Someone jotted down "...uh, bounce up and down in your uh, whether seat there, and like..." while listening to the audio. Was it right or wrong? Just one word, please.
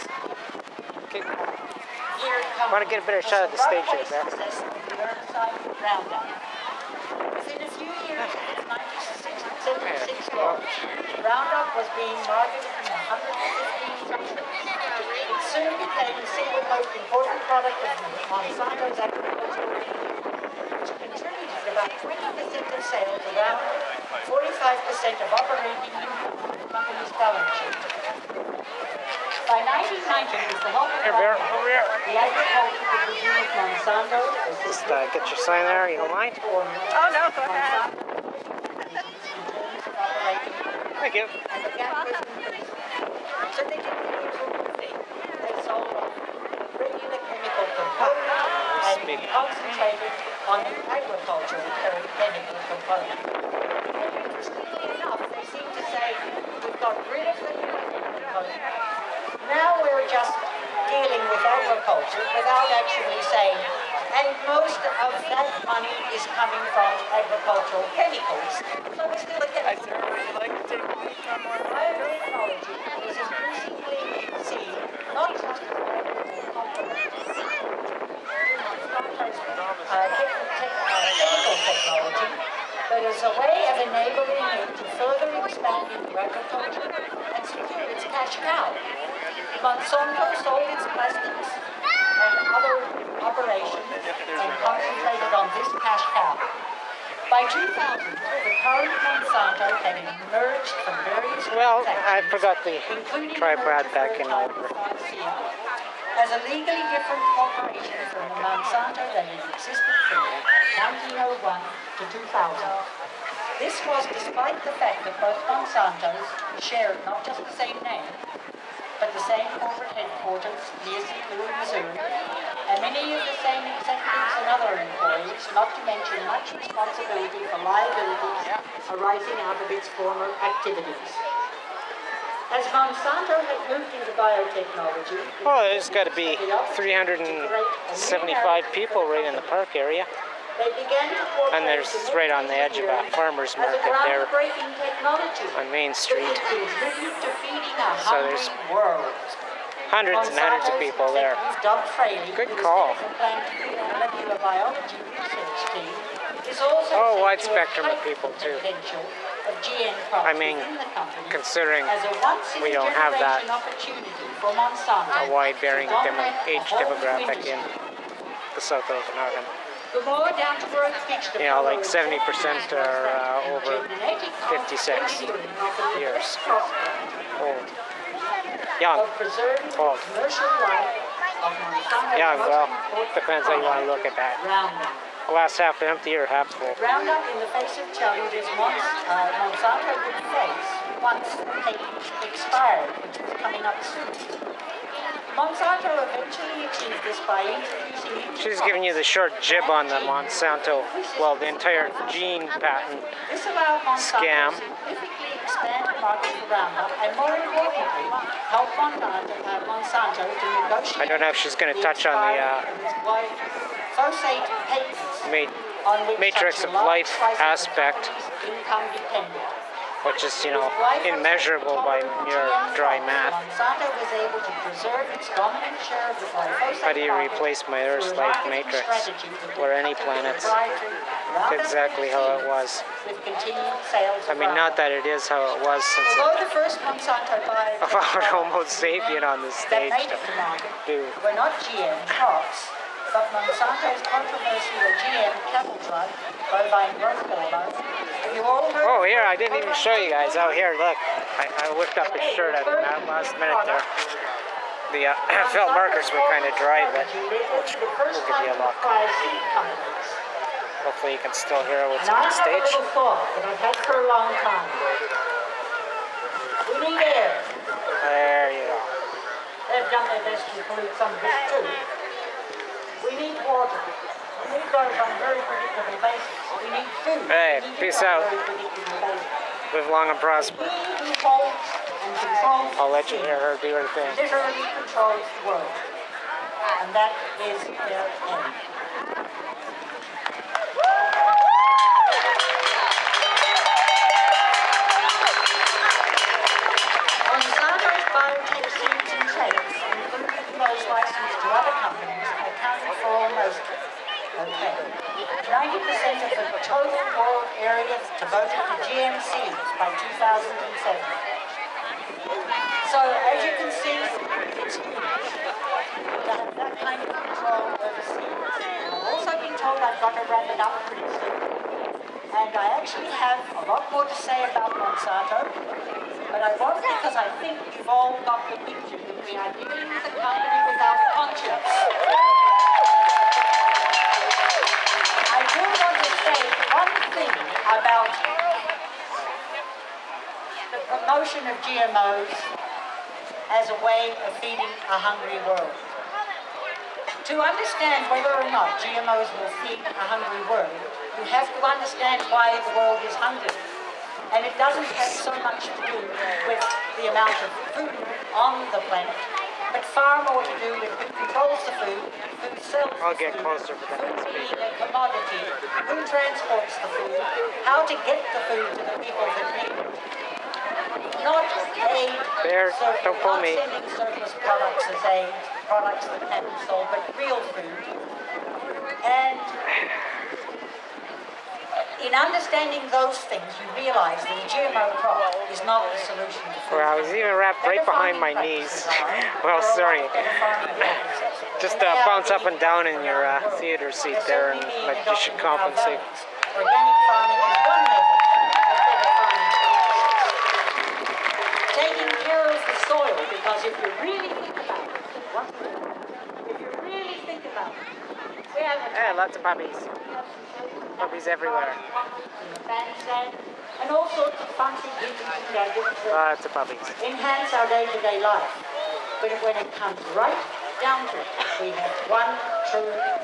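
wrong.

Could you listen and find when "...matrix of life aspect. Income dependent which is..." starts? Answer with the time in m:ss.
3:36.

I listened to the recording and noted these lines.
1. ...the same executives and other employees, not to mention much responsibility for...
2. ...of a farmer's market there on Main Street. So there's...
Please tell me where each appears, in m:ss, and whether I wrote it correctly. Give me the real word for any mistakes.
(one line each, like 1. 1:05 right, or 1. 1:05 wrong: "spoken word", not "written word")
1. 2:03 right
2. 2:22 right.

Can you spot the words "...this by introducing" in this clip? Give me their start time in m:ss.
3:17.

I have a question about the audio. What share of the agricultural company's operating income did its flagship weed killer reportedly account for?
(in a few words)
45%.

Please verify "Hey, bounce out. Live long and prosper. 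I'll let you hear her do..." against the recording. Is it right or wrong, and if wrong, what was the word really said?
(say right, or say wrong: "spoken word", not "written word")
wrong: "peace", not "bounce".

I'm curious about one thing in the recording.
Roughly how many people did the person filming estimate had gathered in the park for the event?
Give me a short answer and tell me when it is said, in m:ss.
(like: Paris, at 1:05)
375, at 2:16.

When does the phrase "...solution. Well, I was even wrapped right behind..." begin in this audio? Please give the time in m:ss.
6:26.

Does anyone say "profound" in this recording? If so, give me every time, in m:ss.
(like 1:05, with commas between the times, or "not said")
not said.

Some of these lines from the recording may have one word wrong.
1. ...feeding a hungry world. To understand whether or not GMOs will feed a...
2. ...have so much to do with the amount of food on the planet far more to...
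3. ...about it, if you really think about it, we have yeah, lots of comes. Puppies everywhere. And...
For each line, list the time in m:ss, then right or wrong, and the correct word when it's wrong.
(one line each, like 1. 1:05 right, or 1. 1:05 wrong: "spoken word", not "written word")
1. 5:44 right
2. 5:55 right
3. 6:44 wrong: "puppies", not "comes".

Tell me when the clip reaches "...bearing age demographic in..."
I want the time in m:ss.
2:45.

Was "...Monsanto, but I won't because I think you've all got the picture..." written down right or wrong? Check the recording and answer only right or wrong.
right.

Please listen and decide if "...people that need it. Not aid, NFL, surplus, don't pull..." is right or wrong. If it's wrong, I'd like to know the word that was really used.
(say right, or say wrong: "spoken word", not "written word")
wrong: "Bear", not "NFL".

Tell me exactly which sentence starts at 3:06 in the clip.
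Roundup in the face of is once uh, Monsanto would face once the they expired, which is coming up soon.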